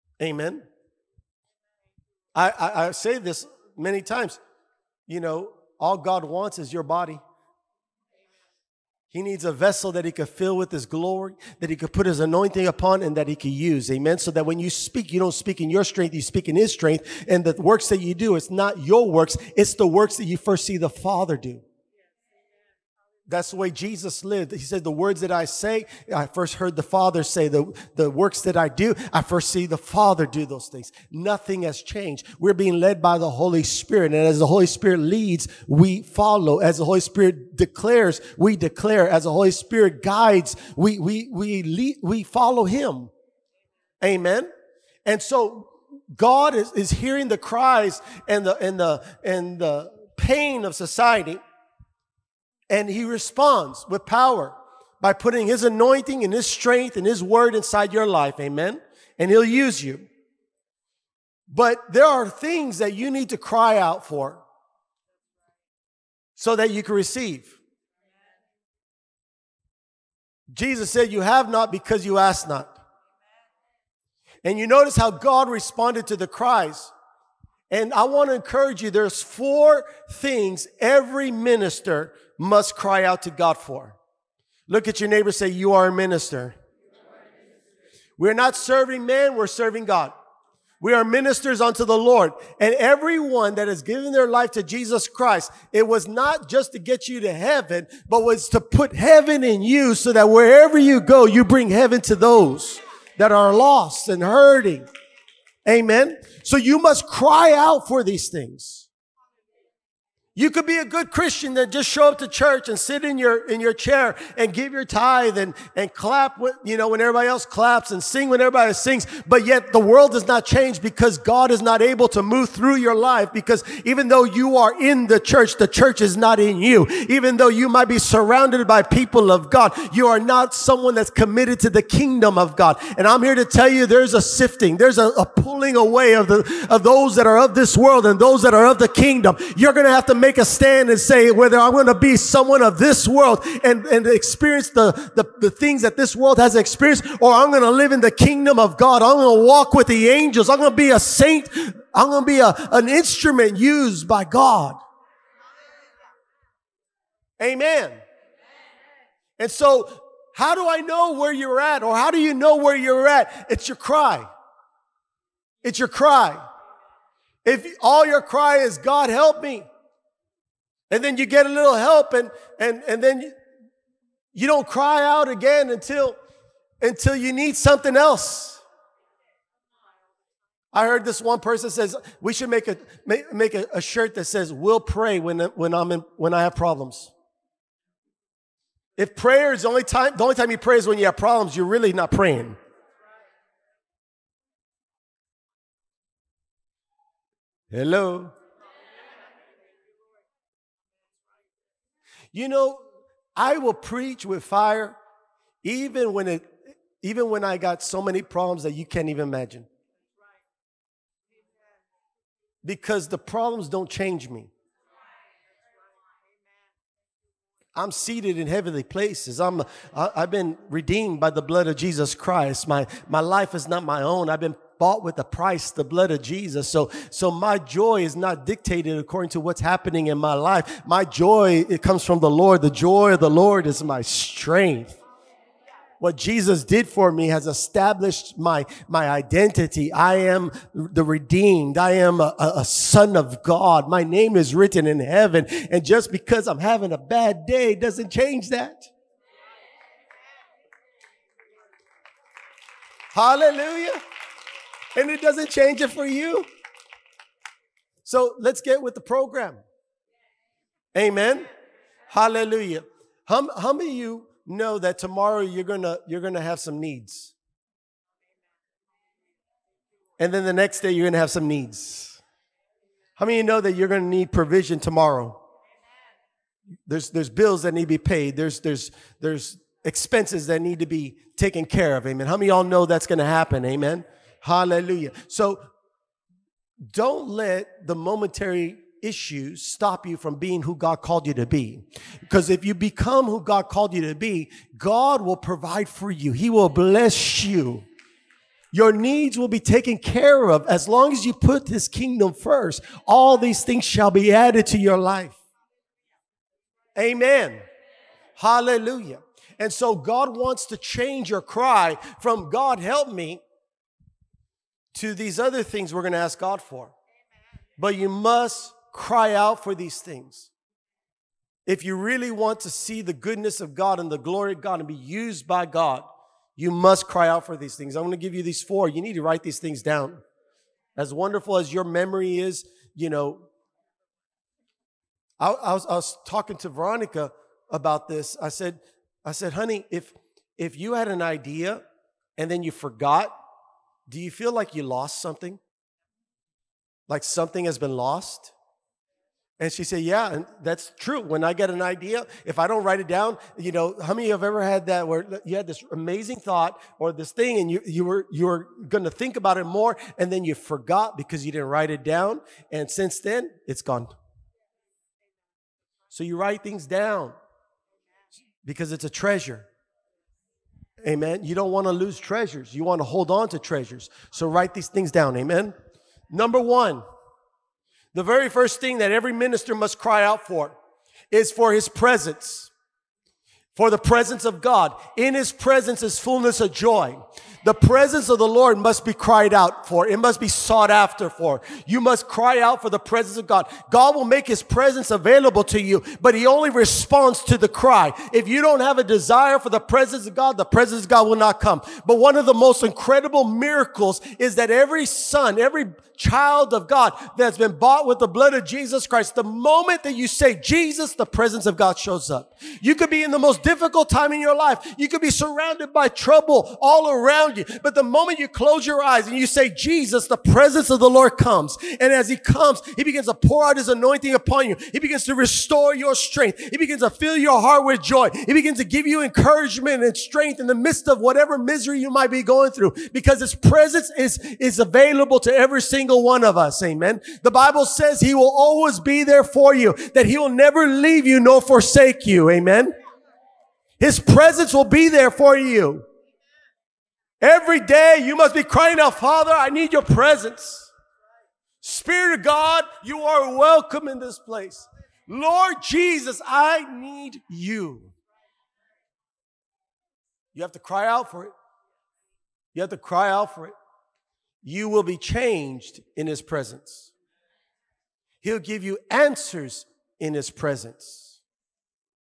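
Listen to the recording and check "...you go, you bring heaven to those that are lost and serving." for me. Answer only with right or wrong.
wrong.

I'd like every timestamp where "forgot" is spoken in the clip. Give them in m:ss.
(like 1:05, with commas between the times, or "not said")
5:42, 6:00.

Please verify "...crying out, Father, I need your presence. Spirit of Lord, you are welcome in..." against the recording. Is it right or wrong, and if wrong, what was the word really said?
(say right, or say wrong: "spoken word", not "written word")
wrong: "God", not "Lord".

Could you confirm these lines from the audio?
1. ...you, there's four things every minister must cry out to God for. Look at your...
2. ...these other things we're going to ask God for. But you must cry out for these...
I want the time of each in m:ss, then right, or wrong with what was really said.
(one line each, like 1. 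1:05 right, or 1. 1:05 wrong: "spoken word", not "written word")
1. 1:18 right
2. 5:15 right.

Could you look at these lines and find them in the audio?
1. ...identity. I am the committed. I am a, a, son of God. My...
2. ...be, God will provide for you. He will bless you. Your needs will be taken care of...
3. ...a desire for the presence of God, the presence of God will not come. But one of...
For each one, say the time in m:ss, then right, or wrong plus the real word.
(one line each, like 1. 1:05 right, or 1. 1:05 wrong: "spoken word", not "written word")
1. 3:59 wrong: "redeemed", not "committed"
2. 4:54 right
3. 6:38 right.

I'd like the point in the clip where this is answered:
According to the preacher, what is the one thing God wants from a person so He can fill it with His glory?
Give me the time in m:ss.
0:06.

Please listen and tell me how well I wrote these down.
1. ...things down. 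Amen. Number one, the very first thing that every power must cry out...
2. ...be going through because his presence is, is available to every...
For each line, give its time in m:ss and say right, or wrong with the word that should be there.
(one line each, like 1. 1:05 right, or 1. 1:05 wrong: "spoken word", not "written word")
1. 6:14 wrong: "minister", not "power"
2. 7:12 right.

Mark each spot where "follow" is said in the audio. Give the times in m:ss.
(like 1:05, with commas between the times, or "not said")
0:36, 0:42.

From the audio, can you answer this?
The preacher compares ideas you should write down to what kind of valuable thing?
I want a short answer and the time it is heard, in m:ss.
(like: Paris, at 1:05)
A treasure, at 6:09.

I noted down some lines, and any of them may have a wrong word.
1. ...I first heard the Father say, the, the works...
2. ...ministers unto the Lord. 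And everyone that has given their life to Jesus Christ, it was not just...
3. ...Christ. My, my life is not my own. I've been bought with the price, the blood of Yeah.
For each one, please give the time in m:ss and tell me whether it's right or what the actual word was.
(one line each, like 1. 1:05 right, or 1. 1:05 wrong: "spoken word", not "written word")
1. 0:26 right
2. 1:31 right
3. 3:42 wrong: "Jesus", not "Yeah".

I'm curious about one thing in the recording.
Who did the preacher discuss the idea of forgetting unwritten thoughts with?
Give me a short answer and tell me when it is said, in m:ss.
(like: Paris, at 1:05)
Veronica, at 5:36.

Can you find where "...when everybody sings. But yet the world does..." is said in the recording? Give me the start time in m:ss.
1:58.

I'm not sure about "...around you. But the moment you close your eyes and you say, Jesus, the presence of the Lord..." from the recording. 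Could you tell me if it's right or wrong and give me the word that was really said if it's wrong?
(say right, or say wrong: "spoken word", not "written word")
right.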